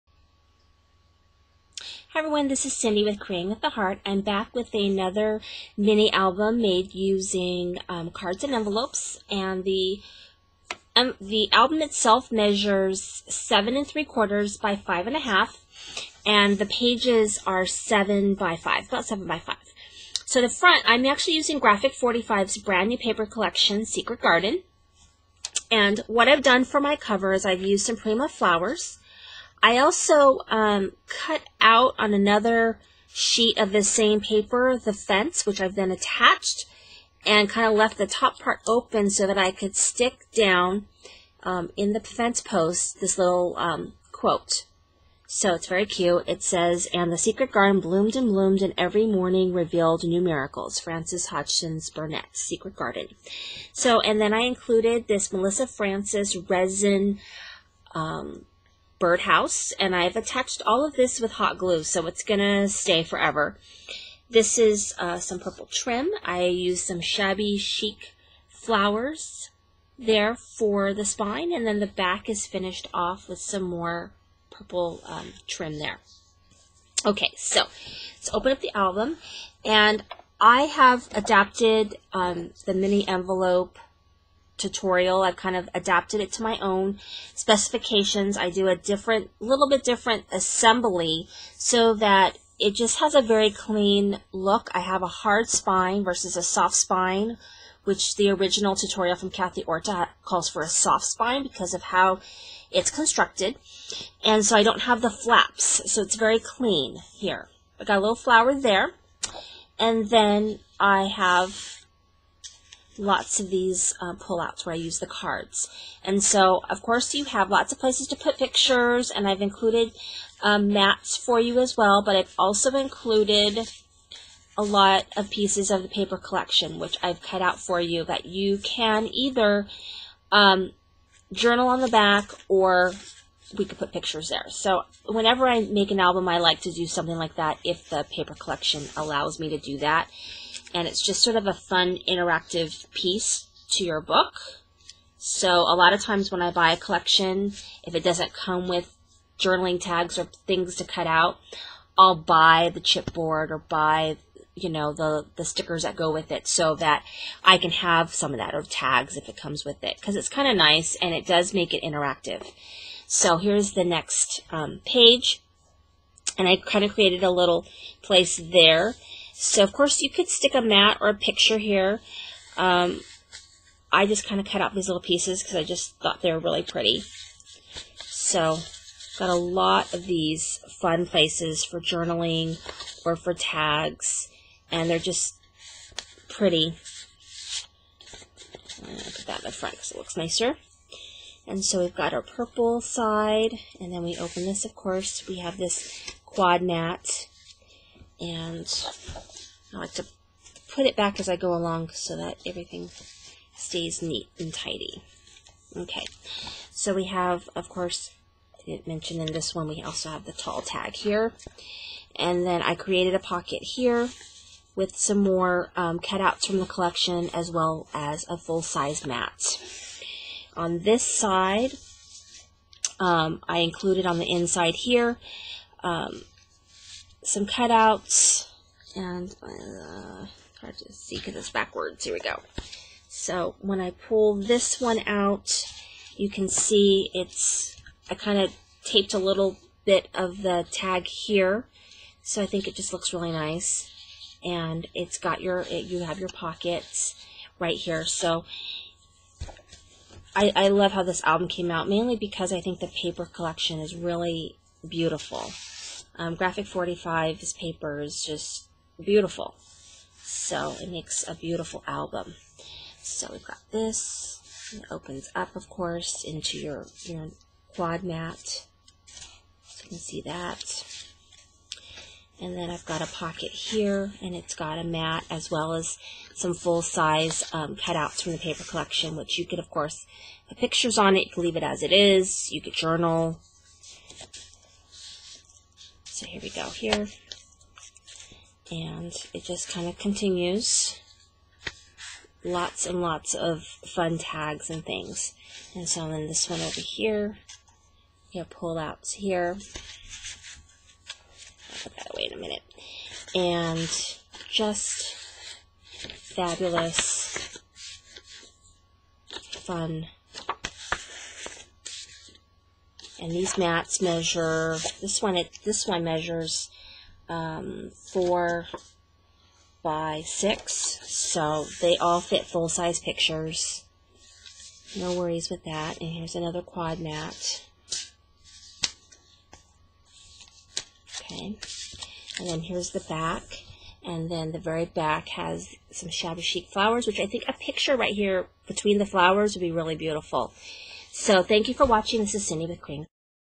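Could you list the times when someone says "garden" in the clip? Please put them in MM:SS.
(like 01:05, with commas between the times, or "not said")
00:24, 00:47, 00:52.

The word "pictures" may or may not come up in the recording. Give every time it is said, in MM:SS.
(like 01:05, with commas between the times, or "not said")
01:58, 02:13, 02:51, 04:40, 05:22, 05:37.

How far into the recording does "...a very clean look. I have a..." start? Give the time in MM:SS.
01:33.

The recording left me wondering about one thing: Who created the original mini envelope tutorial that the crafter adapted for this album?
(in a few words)
Kathy Orta.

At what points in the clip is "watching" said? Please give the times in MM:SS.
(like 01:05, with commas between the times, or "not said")
05:41.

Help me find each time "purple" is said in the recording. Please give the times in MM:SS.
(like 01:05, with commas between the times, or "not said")
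01:05, 01:14, 03:12.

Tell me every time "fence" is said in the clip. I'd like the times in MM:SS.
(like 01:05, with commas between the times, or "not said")
00:34, 00:41.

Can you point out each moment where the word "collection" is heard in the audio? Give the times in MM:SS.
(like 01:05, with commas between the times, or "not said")
00:23, 02:06, 02:18, 02:26, 03:36, 04:13, 04:38.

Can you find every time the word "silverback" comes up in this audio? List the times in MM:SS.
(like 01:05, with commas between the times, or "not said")
not said.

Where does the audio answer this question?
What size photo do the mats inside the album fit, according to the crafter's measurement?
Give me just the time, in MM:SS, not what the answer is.
05:18.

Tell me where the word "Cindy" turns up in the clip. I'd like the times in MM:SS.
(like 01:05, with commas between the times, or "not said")
00:02, 05:42.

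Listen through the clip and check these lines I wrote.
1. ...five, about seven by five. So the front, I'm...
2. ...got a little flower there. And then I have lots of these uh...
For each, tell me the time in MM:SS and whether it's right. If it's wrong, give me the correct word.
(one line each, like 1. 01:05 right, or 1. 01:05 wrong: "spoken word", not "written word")
1. 00:18 right
2. 01:47 right.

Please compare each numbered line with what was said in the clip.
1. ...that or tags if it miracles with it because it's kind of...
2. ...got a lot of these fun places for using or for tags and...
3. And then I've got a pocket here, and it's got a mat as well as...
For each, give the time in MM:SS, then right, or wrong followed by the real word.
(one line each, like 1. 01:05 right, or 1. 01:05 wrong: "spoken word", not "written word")
1. 02:38 wrong: "comes", not "miracles"
2. 02:59 wrong: "journaling", not "using"
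3. 04:32 right.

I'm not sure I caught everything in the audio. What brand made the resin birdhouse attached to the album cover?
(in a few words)
Melissa Frances.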